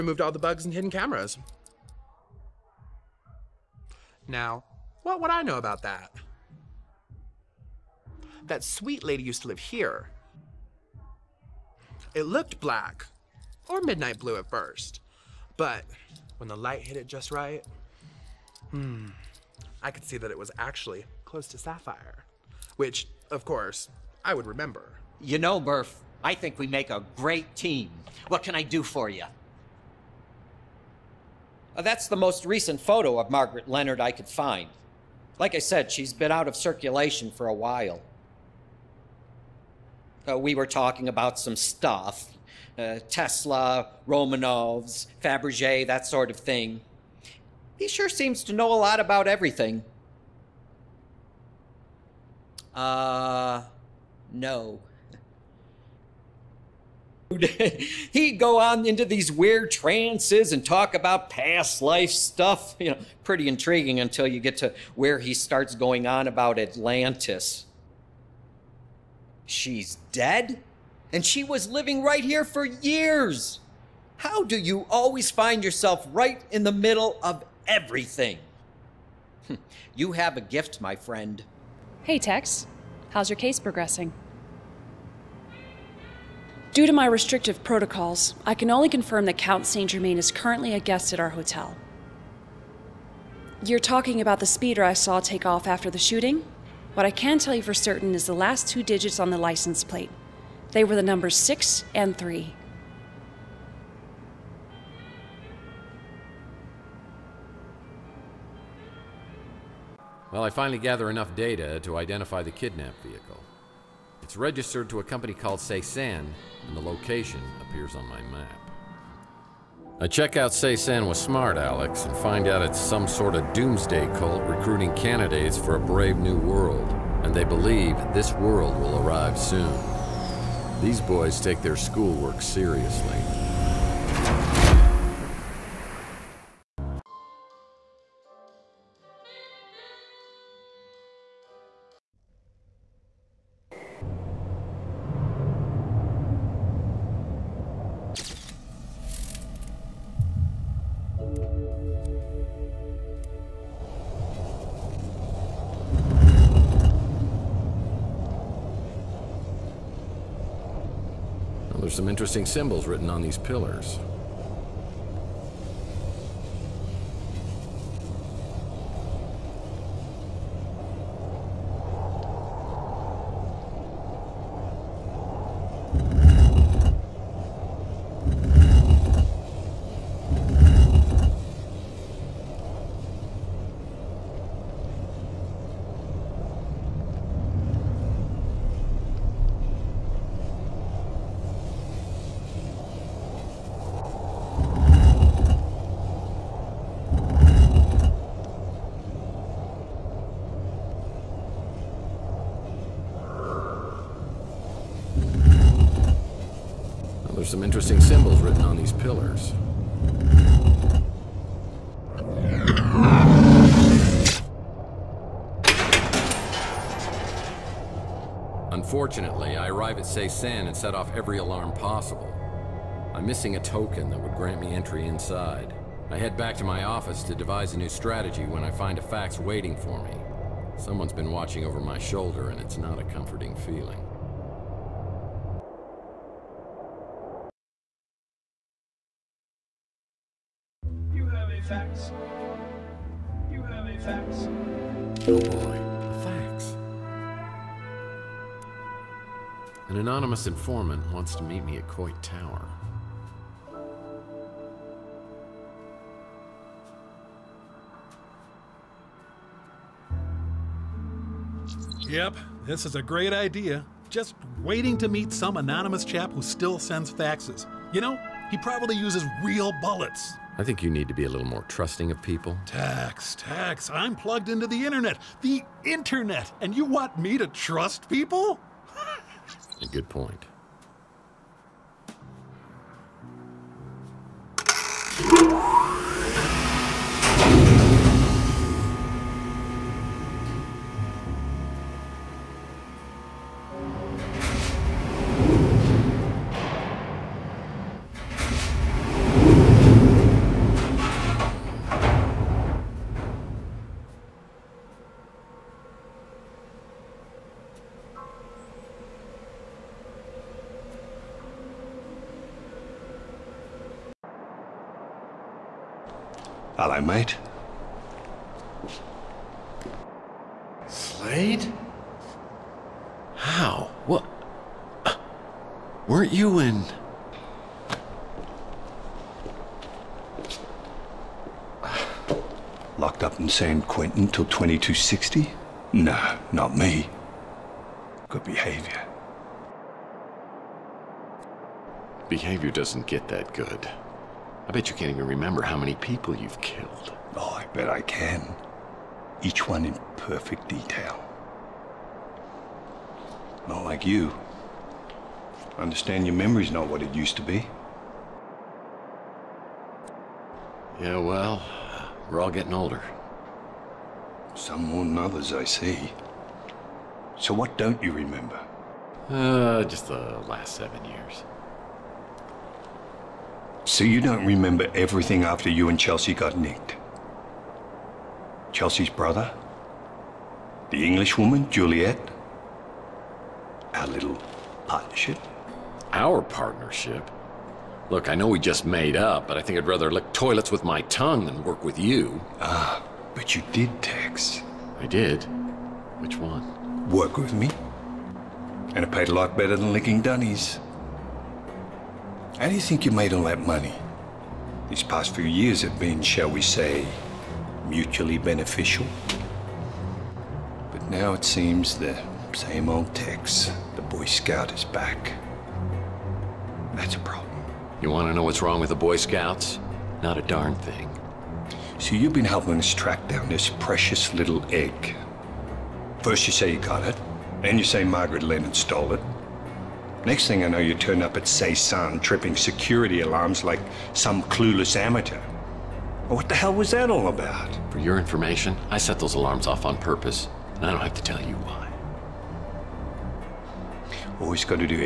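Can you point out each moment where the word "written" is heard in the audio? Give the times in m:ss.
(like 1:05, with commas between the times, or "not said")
2:42, 3:28.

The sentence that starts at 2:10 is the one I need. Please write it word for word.
These boys take their schoolwork seriously.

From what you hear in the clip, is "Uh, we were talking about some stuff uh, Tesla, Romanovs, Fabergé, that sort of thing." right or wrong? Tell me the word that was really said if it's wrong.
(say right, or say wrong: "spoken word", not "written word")
right.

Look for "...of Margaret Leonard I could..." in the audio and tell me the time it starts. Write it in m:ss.
0:33.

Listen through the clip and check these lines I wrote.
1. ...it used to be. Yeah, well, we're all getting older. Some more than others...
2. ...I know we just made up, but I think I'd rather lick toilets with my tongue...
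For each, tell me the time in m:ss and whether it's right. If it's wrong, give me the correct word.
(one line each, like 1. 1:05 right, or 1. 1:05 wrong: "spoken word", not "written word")
1. 5:57 right
2. 6:28 right.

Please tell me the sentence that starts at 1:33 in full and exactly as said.
You're talking about the speeder I saw take off after the shooting?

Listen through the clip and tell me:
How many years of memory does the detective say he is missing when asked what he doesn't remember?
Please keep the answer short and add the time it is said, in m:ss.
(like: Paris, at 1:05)
7, at 6:10.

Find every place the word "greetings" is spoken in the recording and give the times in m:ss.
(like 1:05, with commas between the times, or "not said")
not said.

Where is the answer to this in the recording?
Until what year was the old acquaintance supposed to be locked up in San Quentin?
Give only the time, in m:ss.
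5:34.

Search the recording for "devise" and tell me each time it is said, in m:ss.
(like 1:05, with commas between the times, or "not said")
3:47.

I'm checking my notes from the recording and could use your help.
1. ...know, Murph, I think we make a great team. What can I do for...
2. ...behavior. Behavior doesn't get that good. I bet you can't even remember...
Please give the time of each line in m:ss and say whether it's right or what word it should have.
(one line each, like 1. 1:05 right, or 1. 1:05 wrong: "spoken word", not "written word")
1. 0:25 right
2. 5:38 right.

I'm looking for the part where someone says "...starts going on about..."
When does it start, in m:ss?
1:05.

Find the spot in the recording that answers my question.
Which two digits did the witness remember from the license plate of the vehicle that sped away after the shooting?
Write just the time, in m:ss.
1:41.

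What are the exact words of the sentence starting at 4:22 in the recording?
Yep, this is a great idea.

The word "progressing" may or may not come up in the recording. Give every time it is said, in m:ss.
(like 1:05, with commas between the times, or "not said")
1:23.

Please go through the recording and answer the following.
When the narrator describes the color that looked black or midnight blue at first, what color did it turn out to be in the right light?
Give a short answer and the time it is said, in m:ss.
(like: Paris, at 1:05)
Sapphire, at 0:21.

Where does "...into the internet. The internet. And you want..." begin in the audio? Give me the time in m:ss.
4:34.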